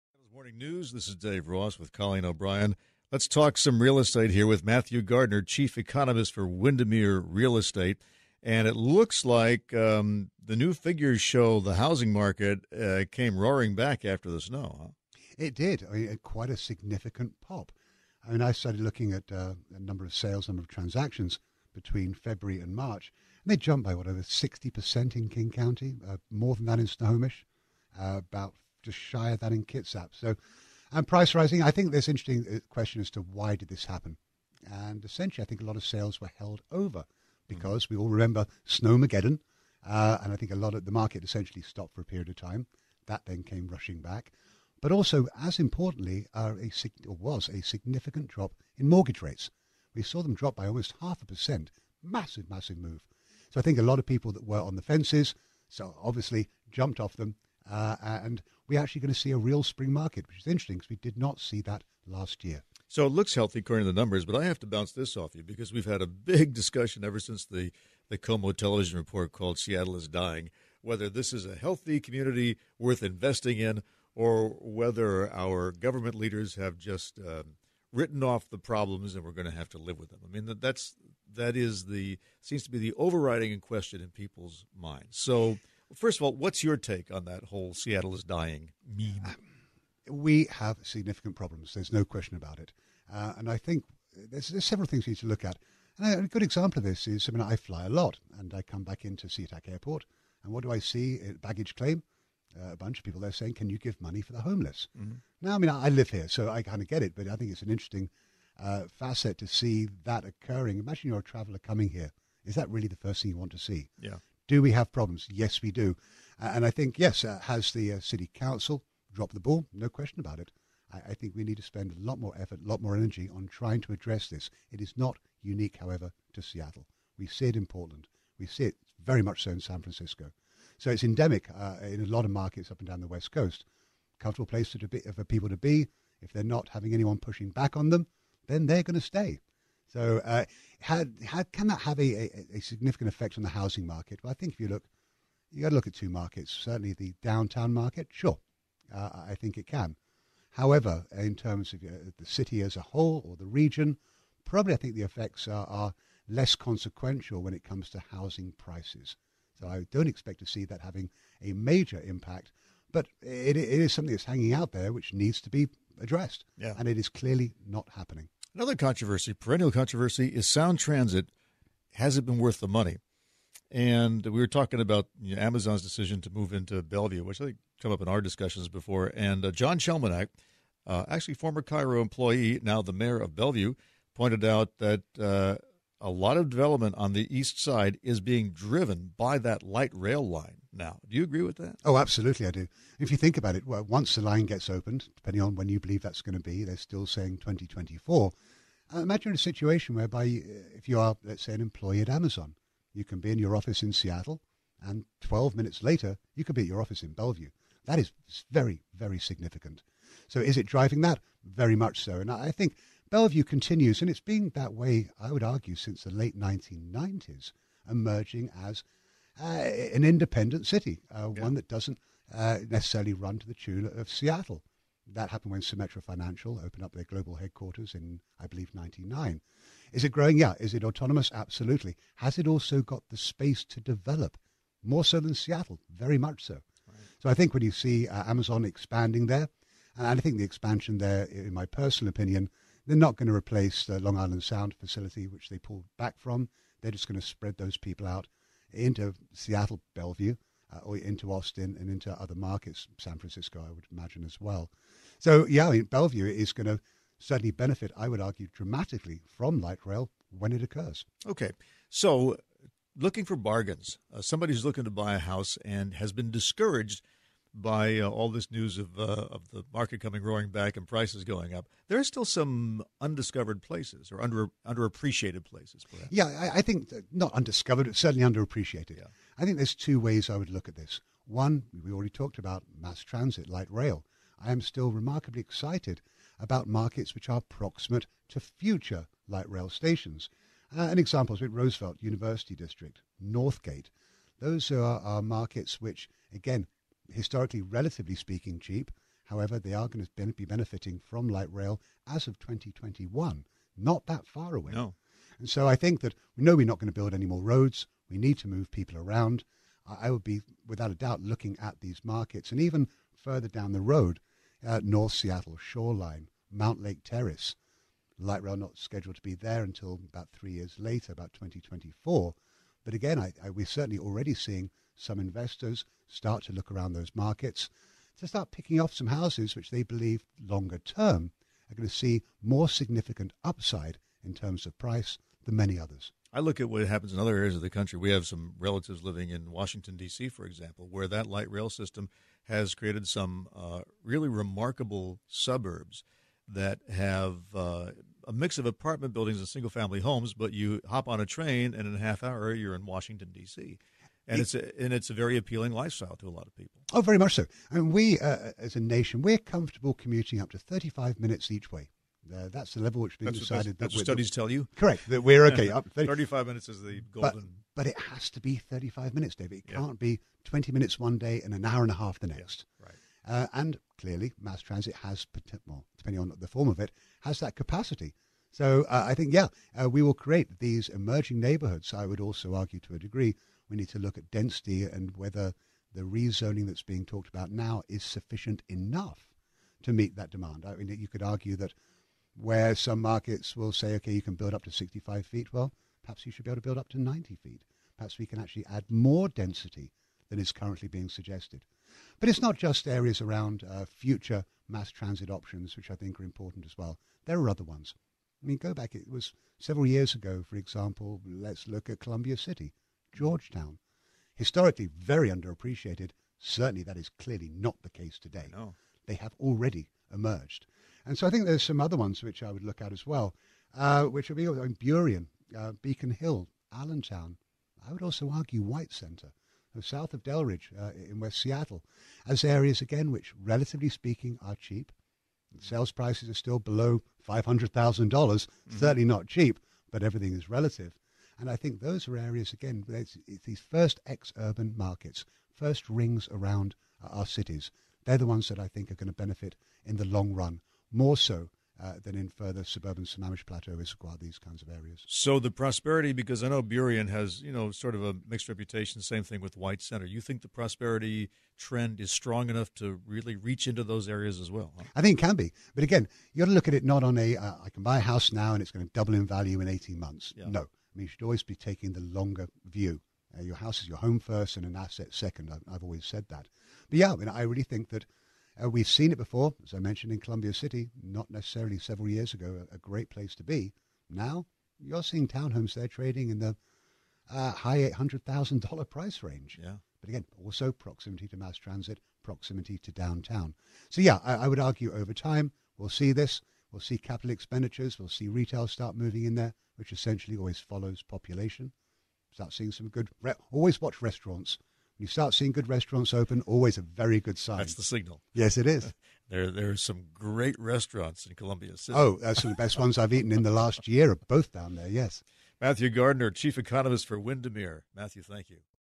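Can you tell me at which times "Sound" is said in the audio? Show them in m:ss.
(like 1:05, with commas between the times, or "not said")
2:50, 4:04.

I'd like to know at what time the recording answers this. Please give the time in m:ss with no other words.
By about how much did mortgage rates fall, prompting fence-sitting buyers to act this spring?
0:50.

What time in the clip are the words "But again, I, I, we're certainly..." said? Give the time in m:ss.
5:22.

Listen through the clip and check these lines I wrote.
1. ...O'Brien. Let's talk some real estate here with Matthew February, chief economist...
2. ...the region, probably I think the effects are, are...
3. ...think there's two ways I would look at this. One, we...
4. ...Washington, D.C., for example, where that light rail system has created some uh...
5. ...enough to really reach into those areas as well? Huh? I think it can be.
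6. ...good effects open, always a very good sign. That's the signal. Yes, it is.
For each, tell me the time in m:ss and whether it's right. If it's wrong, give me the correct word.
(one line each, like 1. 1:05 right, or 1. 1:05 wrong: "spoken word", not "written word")
1. 0:02 wrong: "Gardner", not "February"
2. 2:33 right
3. 4:39 right
4. 5:39 right
5. 7:42 right
6. 8:25 wrong: "restaurants", not "effects".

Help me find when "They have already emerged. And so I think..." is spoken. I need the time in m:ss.
6:59.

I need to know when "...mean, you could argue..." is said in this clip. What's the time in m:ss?
6:30.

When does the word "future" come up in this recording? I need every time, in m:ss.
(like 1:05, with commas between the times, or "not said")
4:48, 6:43.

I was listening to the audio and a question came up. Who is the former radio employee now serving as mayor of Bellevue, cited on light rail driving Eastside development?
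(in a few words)
John Chelminiak.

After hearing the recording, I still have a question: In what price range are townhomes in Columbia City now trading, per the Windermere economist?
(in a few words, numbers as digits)
high $800,000s.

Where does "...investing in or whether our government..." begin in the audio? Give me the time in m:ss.
1:13.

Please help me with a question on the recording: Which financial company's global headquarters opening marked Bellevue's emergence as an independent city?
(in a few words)
Symetra Financial.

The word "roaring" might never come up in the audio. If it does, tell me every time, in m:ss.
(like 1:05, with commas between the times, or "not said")
0:13, 4:30.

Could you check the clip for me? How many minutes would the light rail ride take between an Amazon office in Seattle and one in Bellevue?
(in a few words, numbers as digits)
12.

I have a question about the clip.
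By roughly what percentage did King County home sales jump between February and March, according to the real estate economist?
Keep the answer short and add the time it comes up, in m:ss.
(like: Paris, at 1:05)
60 percent, at 0:24.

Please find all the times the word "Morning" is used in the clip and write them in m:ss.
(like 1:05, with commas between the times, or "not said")
0:00.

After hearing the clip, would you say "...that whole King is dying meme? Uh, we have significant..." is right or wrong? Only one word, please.
wrong.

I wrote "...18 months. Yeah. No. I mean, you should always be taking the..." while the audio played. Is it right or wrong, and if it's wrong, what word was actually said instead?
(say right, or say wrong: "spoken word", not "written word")
right.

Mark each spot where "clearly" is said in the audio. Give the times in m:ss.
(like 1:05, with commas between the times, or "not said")
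2:47, 6:13, 6:57.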